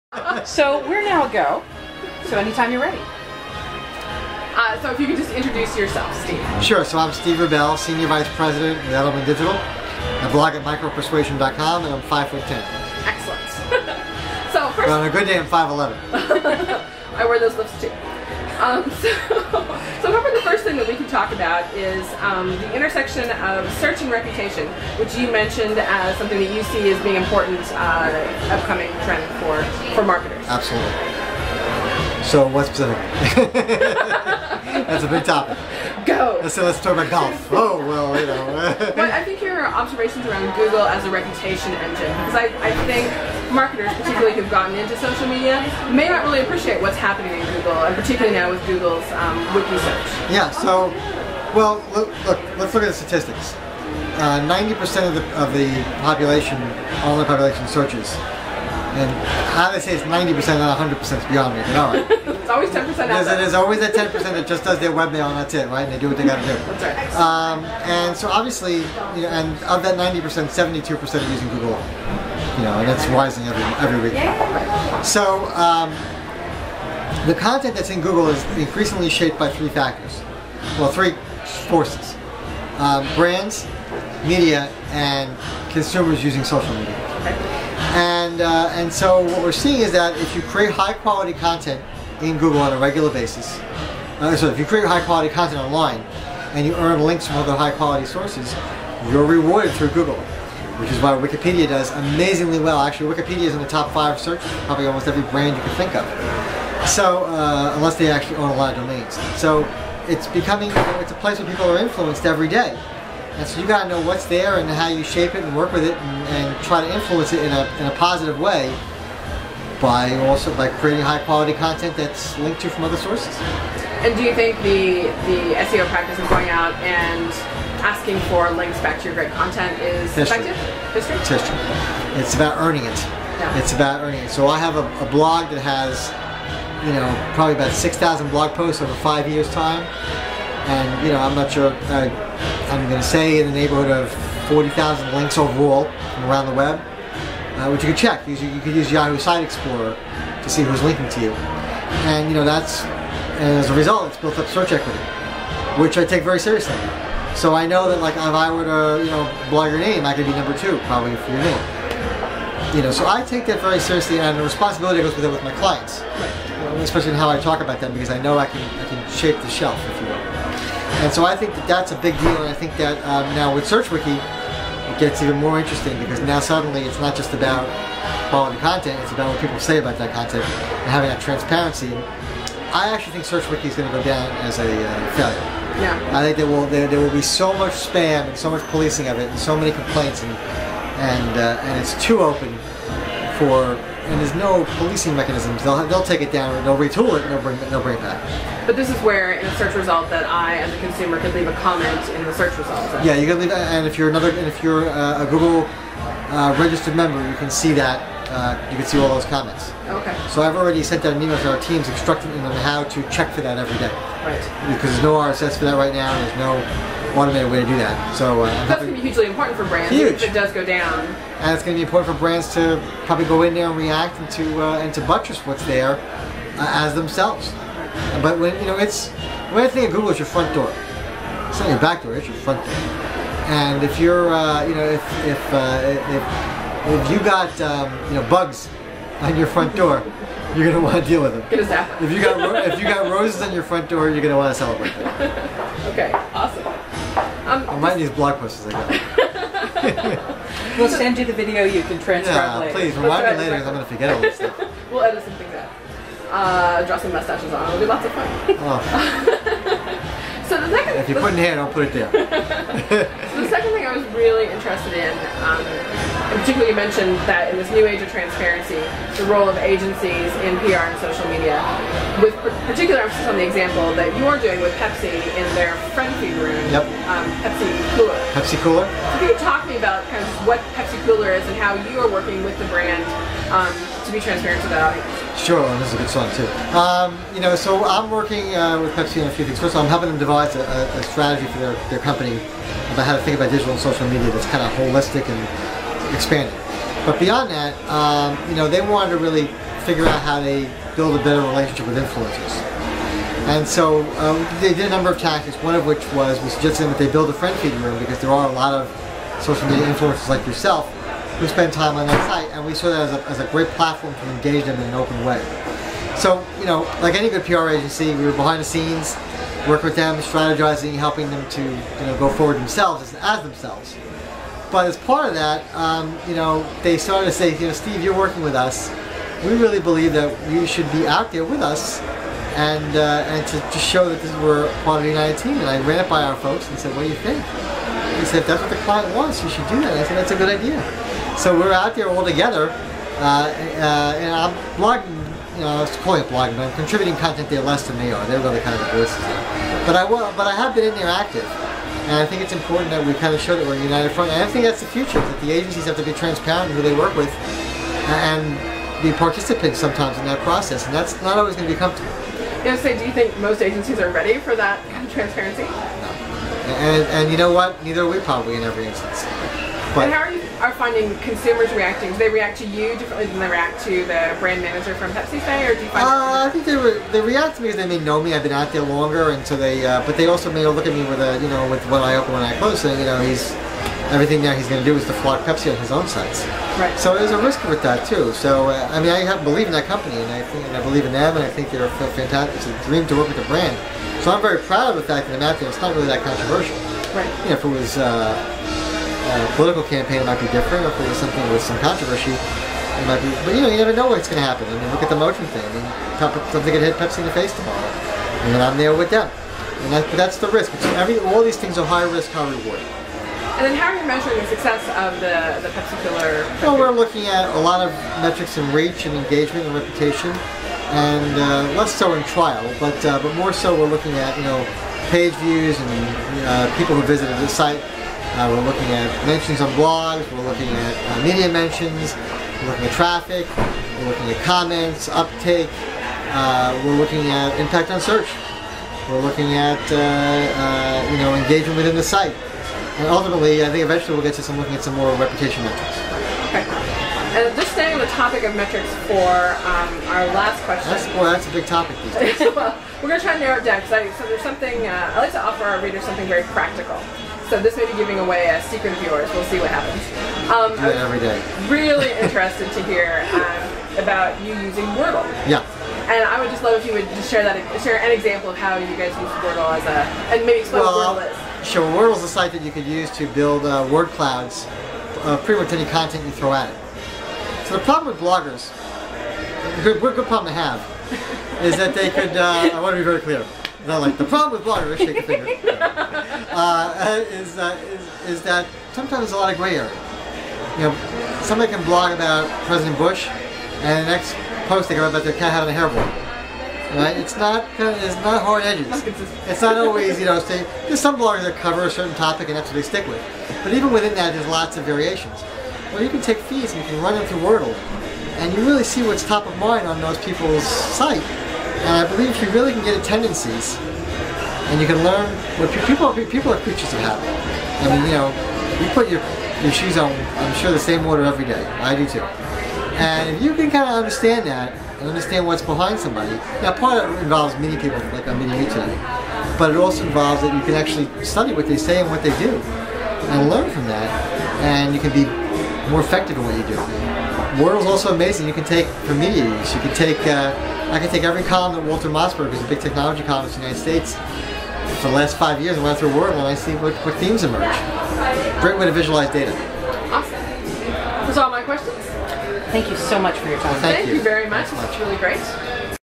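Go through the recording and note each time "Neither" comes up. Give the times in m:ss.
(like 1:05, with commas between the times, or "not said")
6:07.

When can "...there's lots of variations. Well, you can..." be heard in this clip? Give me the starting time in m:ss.
8:24.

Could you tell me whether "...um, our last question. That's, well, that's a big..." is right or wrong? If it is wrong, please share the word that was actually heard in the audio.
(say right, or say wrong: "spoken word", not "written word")
right.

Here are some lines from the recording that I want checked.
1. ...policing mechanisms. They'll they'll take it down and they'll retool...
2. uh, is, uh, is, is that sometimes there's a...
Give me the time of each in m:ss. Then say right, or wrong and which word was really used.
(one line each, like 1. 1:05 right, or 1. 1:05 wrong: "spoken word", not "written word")
1. 3:14 right
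2. 8:06 right.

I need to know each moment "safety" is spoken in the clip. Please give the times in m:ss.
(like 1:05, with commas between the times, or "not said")
not said.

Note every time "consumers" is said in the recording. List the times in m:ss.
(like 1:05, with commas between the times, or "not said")
1:25, 3:20, 6:11.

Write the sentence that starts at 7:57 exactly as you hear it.
So the problem with bloggers, good, good problem to have, is that they could.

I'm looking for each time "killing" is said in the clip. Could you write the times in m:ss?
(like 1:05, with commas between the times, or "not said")
not said.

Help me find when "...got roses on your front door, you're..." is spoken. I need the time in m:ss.
4:02.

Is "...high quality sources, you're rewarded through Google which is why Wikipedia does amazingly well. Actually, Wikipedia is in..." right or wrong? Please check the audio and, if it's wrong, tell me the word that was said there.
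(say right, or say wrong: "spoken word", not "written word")
right.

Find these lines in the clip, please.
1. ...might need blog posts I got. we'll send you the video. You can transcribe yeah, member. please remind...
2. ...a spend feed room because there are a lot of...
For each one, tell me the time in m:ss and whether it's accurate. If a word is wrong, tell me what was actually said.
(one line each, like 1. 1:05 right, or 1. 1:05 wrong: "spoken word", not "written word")
1. 4:07 wrong: "later", not "member"
2. 5:07 wrong: "friend", not "spend".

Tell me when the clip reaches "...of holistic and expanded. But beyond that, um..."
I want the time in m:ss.
4:54.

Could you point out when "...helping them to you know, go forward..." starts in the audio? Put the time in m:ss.
5:20.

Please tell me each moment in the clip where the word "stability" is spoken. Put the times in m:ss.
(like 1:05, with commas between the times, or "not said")
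not said.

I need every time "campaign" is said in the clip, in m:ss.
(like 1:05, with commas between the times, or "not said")
6:39.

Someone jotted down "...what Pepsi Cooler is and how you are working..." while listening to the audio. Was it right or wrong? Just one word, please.
right.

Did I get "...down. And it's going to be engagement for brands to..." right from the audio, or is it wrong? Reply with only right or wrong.
wrong.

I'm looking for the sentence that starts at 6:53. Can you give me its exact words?
And then how are you measuring the success of the, the Pepsi Cooler?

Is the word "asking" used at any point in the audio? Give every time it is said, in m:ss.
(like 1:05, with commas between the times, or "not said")
2:07.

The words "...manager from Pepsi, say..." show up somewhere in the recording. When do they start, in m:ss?
6:14.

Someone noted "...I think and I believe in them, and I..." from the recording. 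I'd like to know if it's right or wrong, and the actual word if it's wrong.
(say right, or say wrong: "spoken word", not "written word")
right.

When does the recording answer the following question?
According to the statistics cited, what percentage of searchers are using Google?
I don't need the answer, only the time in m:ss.
1:10.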